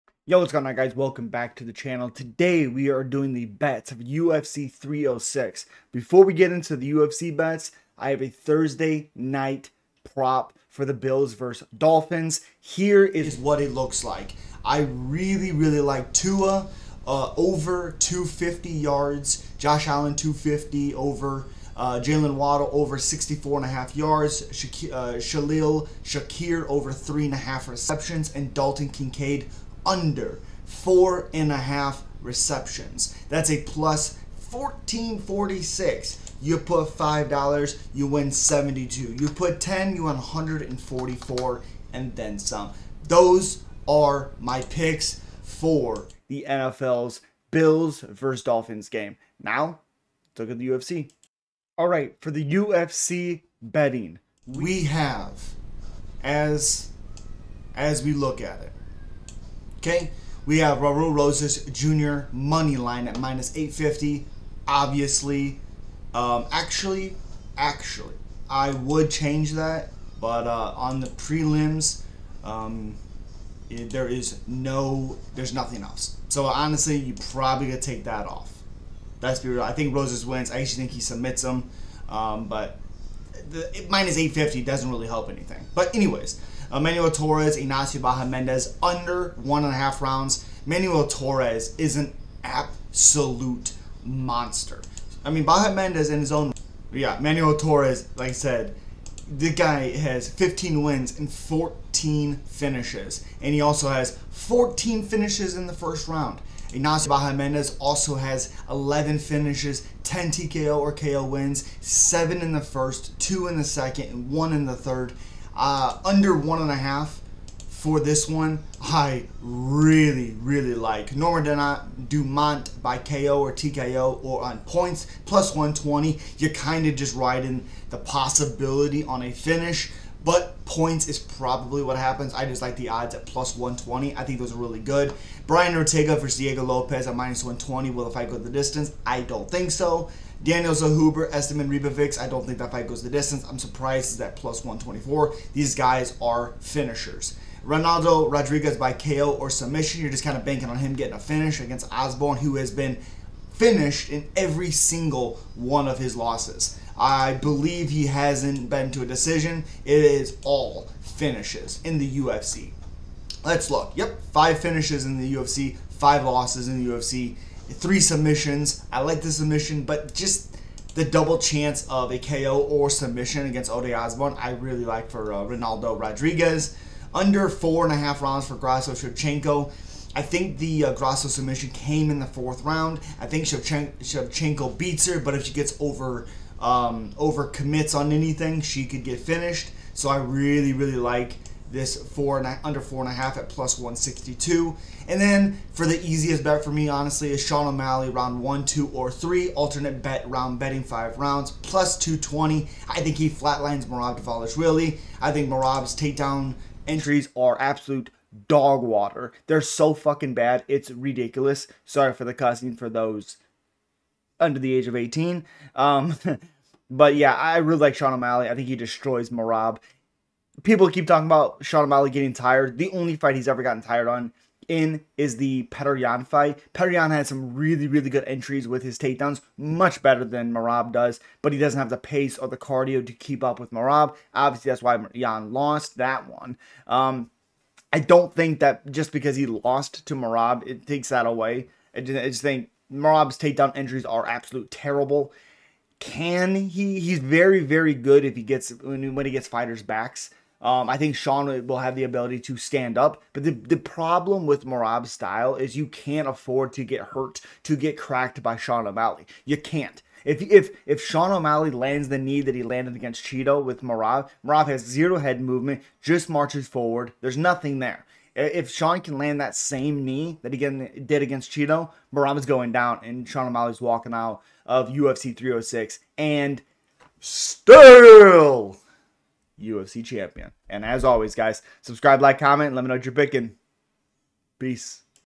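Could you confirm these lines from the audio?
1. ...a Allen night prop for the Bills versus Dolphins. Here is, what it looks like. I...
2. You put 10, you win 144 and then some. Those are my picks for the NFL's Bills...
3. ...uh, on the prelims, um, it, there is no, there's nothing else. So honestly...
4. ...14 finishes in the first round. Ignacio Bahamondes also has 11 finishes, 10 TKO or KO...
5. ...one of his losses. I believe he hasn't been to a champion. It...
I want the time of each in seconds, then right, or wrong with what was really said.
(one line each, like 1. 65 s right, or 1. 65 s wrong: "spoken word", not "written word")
1. 8 s wrong: "Thursday", not "Allen"
2. 39 s right
3. 70 s right
4. 104 s right
5. 155 s wrong: "decision", not "champion".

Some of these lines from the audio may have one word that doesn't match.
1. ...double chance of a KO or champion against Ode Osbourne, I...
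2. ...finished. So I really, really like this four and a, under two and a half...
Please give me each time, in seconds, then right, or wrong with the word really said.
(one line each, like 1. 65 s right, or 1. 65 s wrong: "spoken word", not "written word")
1. 171 s wrong: "submission", not "champion"
2. 189 s wrong: "four", not "two".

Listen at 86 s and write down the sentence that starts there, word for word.
Emmanuel Torres, Ignacio Bahamondes under one and a half rounds.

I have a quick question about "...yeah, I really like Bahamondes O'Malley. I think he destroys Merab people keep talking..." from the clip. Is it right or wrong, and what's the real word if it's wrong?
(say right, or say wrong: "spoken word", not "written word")
wrong: "Sean", not "Bahamondes".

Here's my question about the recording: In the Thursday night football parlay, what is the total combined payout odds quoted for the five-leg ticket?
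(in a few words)
+1446.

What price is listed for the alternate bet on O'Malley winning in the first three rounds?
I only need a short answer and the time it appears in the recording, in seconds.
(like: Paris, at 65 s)
+220, at 201 s.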